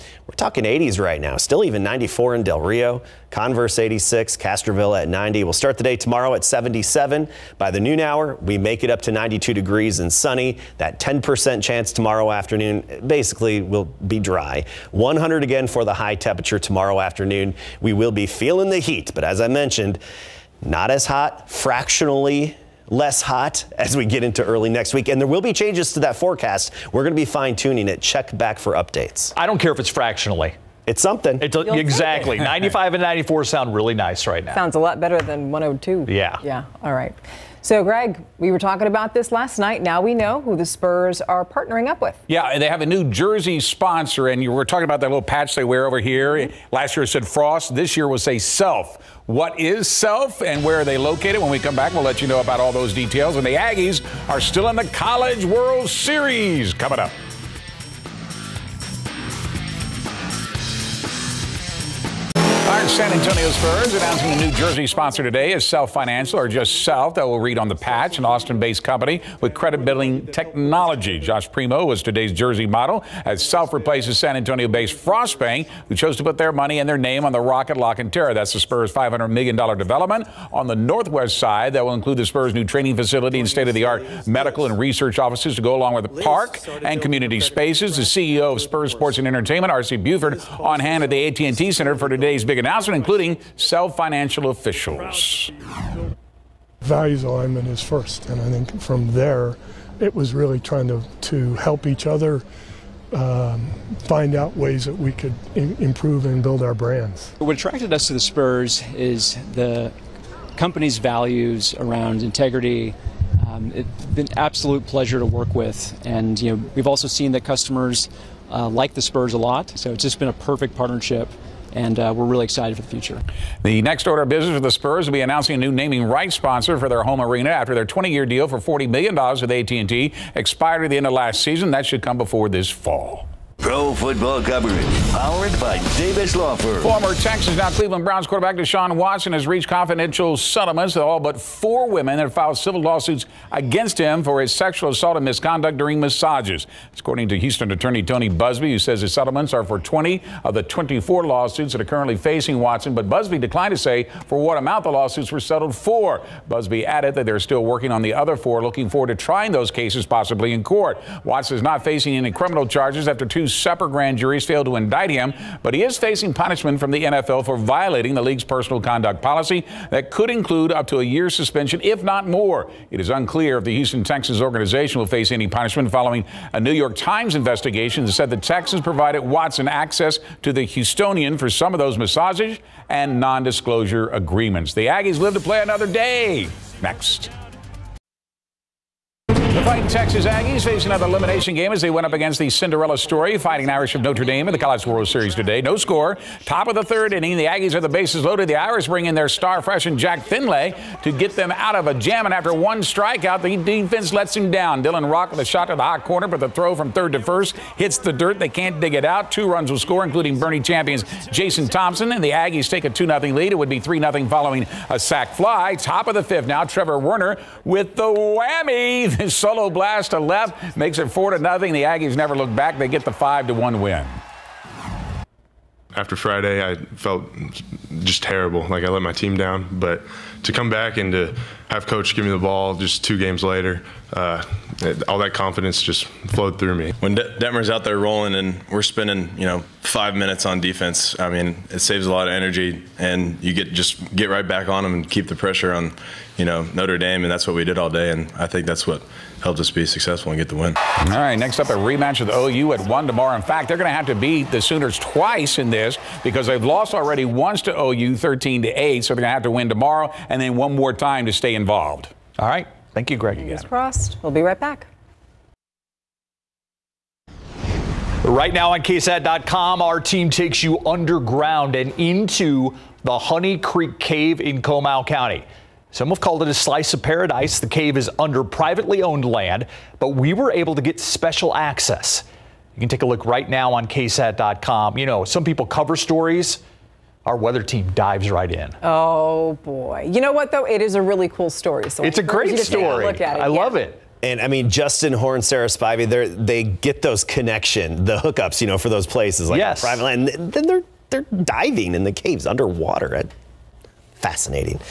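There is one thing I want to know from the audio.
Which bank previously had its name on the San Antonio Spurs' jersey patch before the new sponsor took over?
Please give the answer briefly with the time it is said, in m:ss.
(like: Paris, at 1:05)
Frost Bank, at 1:14.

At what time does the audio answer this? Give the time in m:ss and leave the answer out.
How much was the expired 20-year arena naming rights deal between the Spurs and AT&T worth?
2:08.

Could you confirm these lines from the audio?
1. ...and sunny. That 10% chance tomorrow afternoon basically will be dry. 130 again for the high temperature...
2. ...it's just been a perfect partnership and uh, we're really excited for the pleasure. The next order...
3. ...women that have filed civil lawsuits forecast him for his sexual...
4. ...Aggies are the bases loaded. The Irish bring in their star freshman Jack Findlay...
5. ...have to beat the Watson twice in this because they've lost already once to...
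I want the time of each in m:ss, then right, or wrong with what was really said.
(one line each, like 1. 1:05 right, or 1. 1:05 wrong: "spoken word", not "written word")
1. 0:09 wrong: "100", not "130"
2. 1:59 wrong: "future", not "pleasure"
3. 2:21 wrong: "against", not "forecast"
4. 3:17 right
5. 4:13 wrong: "Sooners", not "Watson".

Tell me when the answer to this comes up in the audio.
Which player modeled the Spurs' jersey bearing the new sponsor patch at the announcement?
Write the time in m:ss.
1:11.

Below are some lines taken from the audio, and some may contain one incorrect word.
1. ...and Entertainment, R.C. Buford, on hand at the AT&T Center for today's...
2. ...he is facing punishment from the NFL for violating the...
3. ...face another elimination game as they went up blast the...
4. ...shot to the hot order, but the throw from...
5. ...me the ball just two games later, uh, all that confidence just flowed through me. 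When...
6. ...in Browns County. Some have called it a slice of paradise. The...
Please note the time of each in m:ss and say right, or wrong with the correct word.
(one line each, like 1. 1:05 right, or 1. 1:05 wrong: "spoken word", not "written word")
1. 1:29 right
2. 2:45 right
3. 3:10 wrong: "against", not "blast"
4. 3:25 wrong: "corner", not "order"
5. 3:52 right
6. 4:34 wrong: "Comal", not "Browns".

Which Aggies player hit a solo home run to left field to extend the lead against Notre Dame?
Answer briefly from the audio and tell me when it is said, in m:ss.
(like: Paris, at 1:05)
Trevor Werner, at 3:36.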